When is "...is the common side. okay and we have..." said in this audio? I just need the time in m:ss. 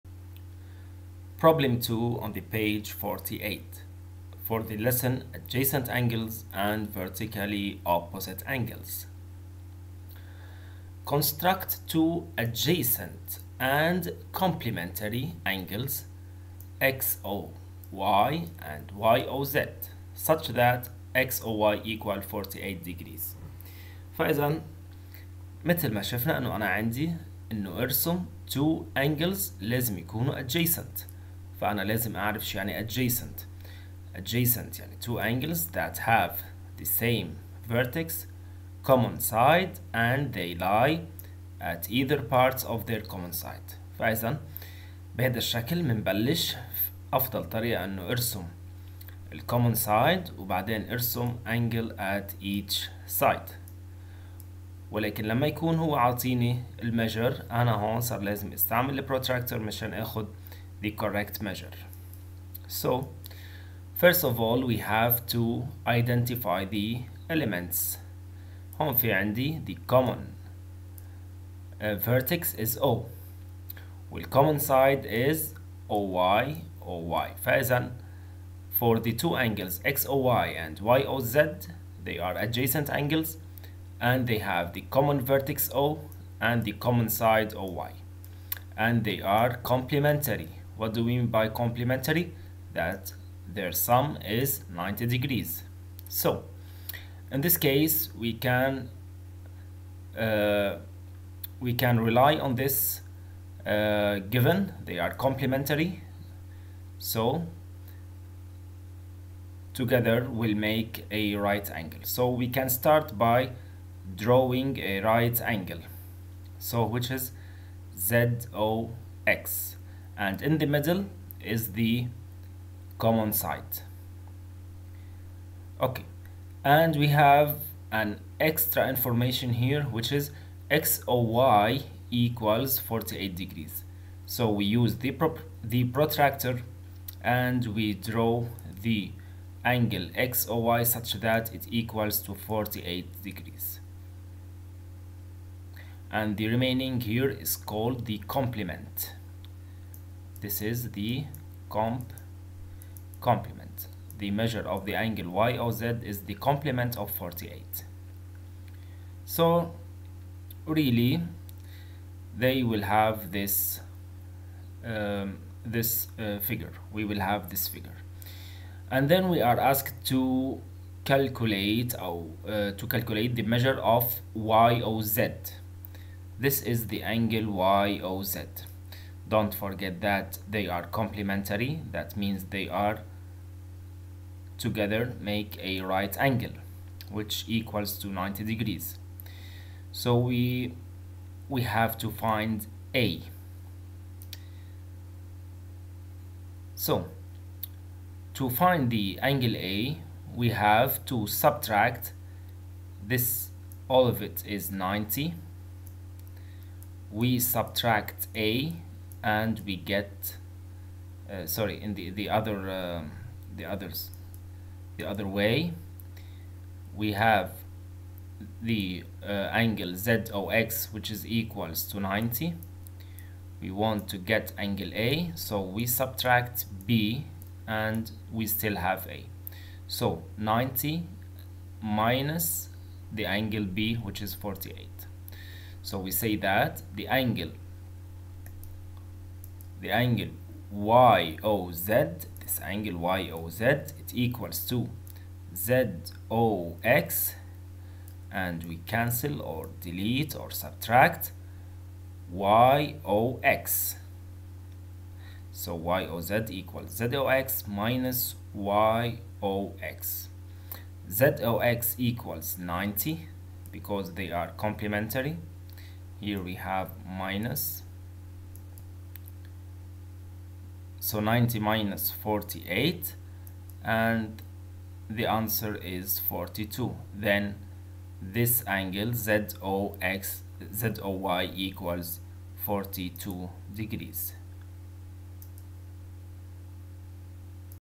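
2:01.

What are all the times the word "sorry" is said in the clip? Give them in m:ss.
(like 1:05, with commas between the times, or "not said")
3:31.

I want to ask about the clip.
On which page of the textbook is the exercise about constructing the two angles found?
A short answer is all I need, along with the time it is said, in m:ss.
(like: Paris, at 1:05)
48, at 0:02.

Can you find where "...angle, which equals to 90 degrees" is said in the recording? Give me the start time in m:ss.
3:06.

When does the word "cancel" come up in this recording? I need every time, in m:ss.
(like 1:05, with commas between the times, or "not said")
4:08.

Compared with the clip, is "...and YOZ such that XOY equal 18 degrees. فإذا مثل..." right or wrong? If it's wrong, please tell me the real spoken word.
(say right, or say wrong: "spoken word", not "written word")
wrong: "48", not "18".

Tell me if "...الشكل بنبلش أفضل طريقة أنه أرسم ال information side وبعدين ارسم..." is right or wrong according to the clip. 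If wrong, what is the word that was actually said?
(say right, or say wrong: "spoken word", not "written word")
wrong: "common", not "information".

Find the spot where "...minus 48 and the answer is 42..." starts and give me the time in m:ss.
4:31.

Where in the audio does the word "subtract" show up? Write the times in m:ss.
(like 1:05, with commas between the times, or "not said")
3:21, 3:27, 3:45, 4:10.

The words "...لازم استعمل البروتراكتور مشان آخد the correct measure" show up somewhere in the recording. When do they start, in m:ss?
0:58.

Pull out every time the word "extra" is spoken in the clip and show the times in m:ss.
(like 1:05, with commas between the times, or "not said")
2:08.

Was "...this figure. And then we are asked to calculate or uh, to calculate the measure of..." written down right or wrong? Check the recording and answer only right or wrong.
right.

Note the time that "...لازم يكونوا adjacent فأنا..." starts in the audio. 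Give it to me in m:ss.
0:29.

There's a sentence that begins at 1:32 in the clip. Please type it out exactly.
That their sum is 90 degrees.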